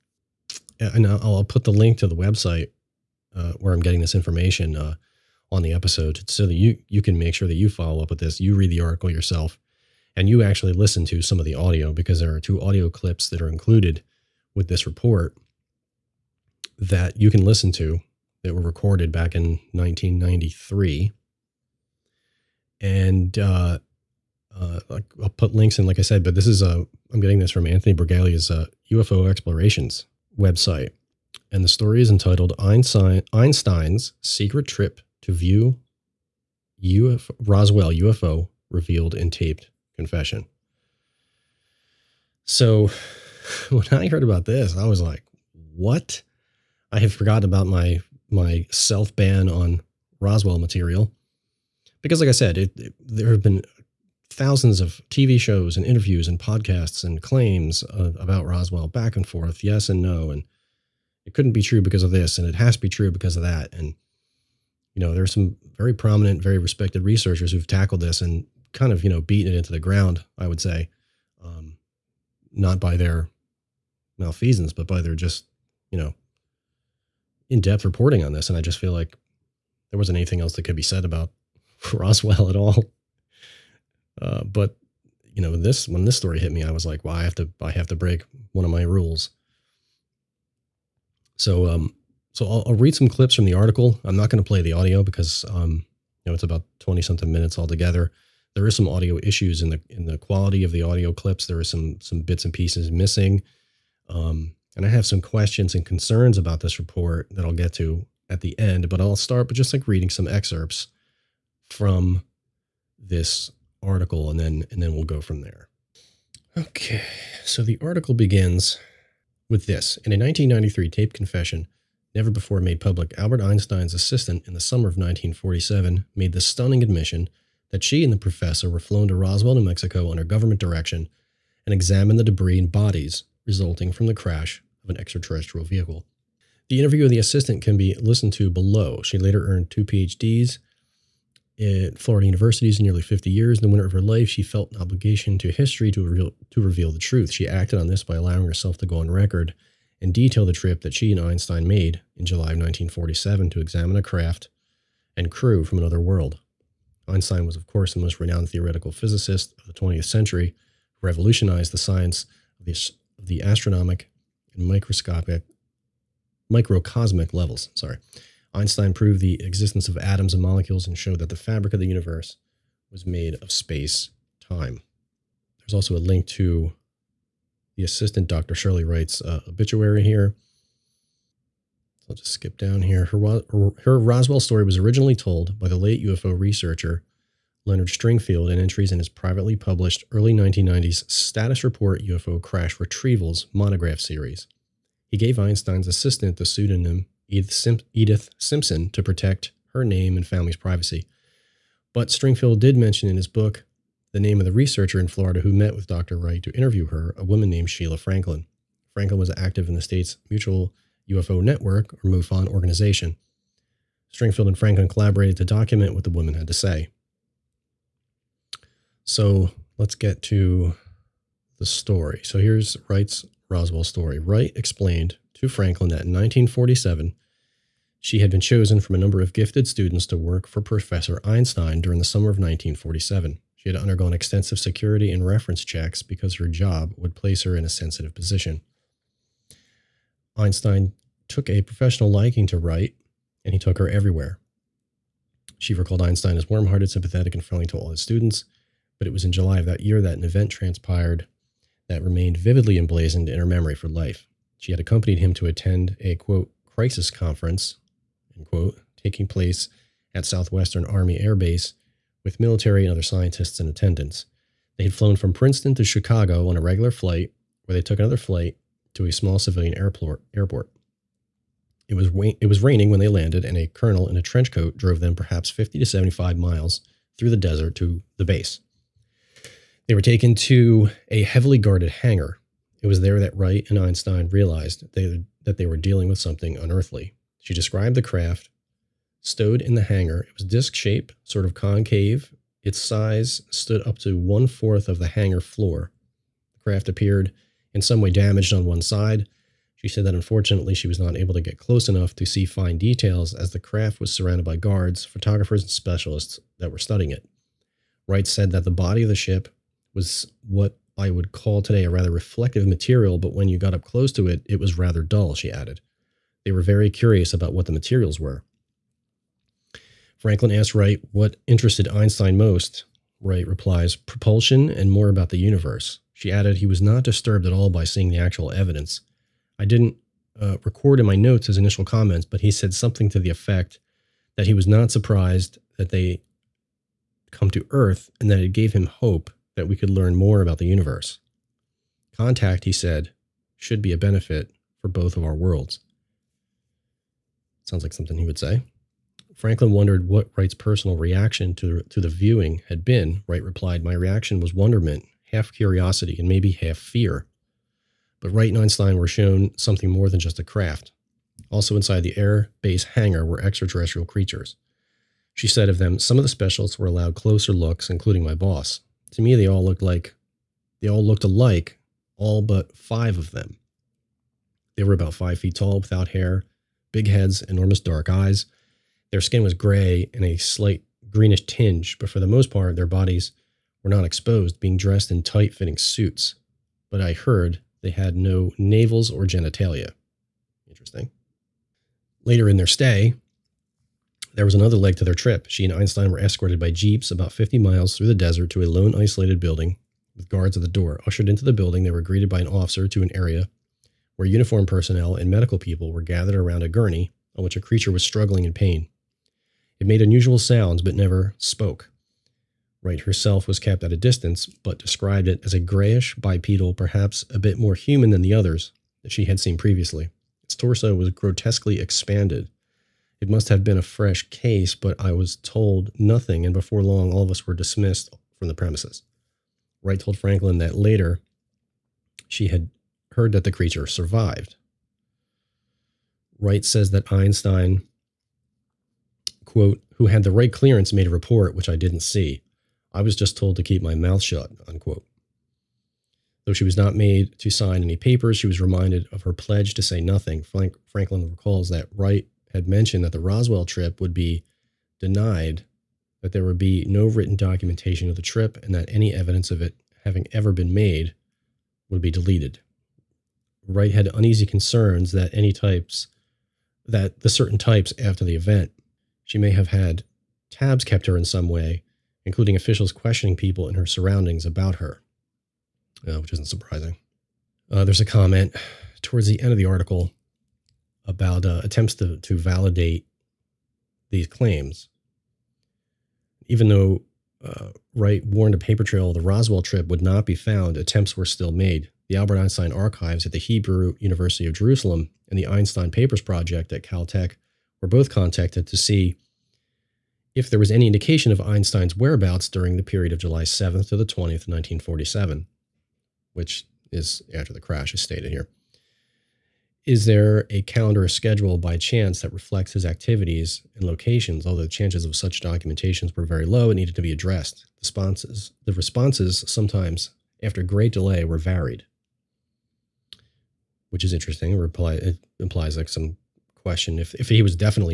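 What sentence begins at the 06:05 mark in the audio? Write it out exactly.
She said of them, Some of the specialists were allowed closer looks, including my boss.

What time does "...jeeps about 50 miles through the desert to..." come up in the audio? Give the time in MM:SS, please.
06:36.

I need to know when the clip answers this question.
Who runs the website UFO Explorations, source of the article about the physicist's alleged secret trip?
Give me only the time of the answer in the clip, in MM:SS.
00:27.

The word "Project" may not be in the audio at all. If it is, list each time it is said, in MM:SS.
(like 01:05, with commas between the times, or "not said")
08:16.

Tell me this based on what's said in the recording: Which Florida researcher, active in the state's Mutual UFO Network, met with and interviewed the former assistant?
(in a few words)
Sheila Franklin.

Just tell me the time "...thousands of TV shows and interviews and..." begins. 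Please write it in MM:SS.
00:54.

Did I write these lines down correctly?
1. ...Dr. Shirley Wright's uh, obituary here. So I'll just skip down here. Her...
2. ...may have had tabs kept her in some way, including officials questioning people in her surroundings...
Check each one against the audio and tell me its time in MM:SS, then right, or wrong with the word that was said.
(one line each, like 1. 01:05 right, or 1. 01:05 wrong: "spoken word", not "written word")
1. 02:58 right
2. 07:49 right.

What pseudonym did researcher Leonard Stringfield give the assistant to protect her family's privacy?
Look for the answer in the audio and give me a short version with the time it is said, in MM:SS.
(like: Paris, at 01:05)
Edith Simpson, at 03:17.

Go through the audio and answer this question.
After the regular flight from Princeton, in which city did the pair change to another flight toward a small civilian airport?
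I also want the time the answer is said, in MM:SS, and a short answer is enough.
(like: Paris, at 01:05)
Chicago, at 04:25.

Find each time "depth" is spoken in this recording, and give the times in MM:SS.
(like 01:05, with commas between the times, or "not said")
01:17.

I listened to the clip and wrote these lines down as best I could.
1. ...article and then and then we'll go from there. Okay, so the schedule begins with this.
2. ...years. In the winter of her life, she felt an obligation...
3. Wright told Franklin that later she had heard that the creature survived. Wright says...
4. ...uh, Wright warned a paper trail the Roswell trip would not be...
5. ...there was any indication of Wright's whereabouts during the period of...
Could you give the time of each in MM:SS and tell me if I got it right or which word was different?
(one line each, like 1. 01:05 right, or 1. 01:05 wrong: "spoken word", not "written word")
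1. 01:53 wrong: "article", not "schedule"
2. 02:23 right
3. 07:09 right
4. 08:07 right
5. 08:20 wrong: "Einstein", not "Wright".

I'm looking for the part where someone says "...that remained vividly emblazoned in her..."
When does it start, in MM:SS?
04:11.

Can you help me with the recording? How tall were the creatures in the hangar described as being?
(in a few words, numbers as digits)
5 feet.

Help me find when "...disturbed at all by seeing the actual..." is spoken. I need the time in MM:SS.
05:27.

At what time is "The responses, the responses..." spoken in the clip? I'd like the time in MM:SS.
08:37.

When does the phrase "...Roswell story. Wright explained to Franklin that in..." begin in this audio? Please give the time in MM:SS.
03:43.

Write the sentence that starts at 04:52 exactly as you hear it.
Its size stood up to one fourth of the hangar floor.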